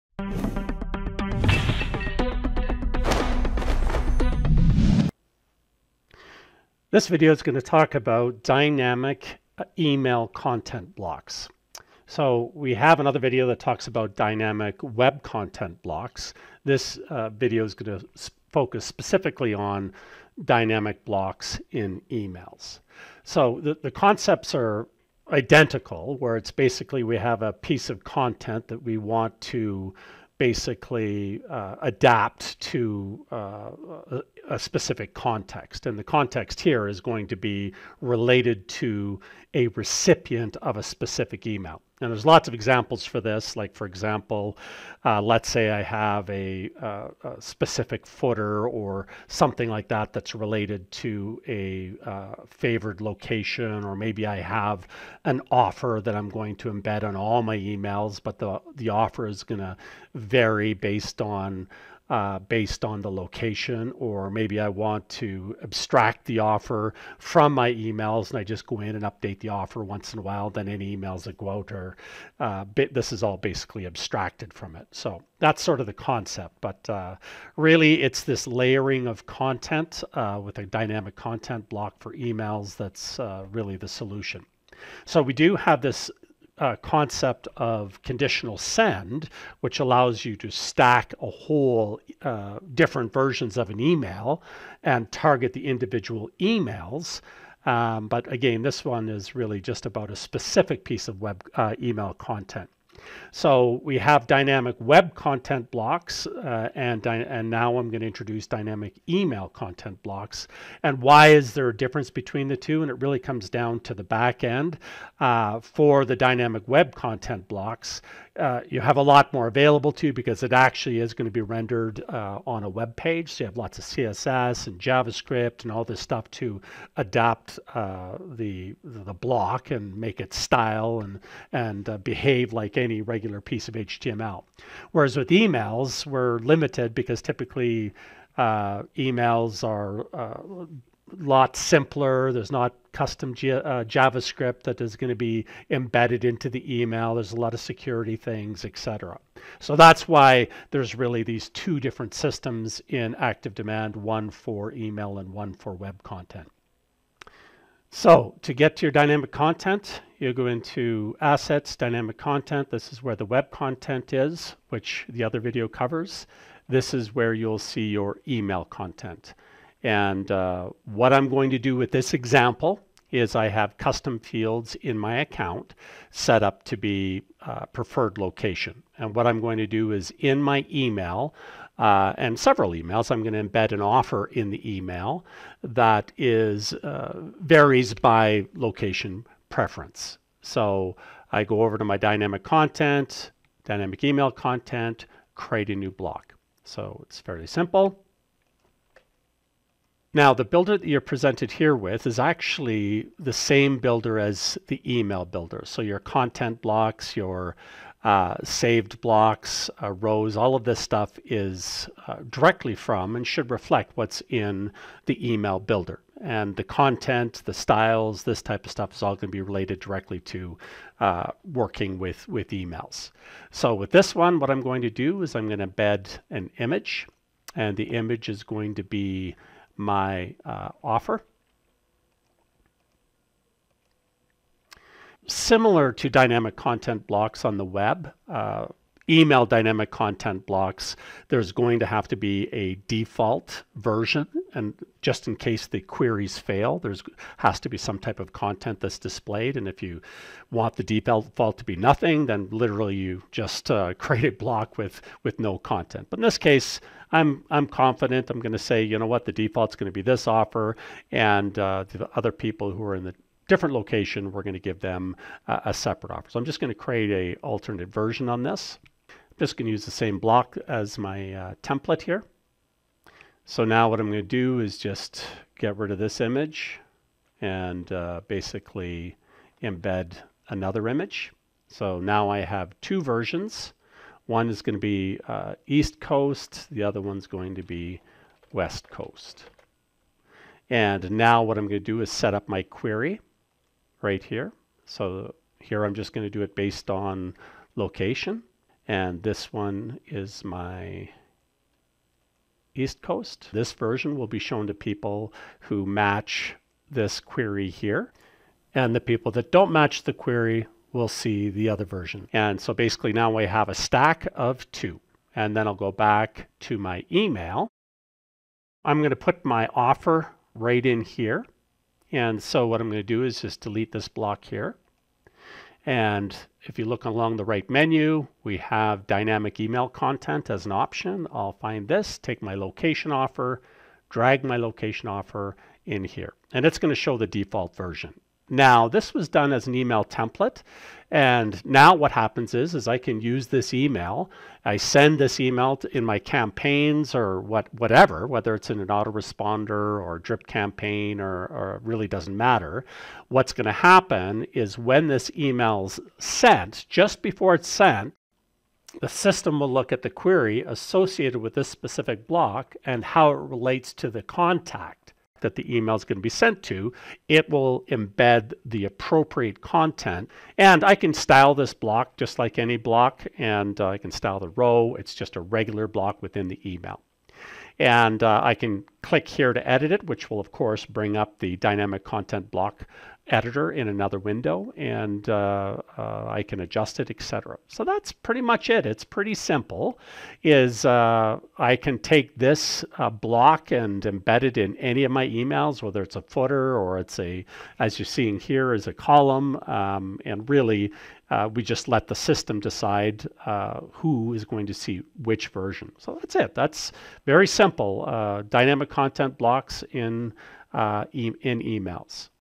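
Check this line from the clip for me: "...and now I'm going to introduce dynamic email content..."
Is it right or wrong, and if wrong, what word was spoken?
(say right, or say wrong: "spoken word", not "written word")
right.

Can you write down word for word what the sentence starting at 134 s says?
Whereas with emails, we're limited because typically uh, emails are a uh, lot simpler.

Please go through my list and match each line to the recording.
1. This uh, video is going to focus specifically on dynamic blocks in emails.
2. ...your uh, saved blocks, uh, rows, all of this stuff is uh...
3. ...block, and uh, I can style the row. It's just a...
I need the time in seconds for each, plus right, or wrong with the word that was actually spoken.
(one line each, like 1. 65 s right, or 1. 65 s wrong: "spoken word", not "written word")
1. 16 s right
2. 207 s right
3. 372 s right.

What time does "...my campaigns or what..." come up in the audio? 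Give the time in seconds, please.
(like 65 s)
346 s.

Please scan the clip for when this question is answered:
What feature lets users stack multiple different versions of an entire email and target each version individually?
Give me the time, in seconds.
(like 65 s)
88 s.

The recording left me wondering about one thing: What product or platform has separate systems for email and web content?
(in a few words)
Active Demand.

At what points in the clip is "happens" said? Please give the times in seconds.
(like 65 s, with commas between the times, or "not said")
342 s, 353 s.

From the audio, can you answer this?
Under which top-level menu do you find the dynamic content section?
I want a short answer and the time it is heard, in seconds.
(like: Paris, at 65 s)
Assets, at 161 s.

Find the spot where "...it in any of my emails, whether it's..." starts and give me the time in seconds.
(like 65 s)
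394 s.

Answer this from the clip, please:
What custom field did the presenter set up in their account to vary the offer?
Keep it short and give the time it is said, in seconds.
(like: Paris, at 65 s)
preferred location, at 177 s.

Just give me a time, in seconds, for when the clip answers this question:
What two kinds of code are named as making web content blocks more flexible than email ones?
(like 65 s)
123 s.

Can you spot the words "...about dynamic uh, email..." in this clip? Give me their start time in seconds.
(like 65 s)
7 s.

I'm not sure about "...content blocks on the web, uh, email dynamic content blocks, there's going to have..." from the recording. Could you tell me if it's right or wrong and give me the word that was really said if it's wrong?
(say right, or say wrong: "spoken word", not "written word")
right.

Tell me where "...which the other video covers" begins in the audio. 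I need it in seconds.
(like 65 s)
164 s.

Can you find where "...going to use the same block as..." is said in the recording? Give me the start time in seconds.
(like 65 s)
269 s.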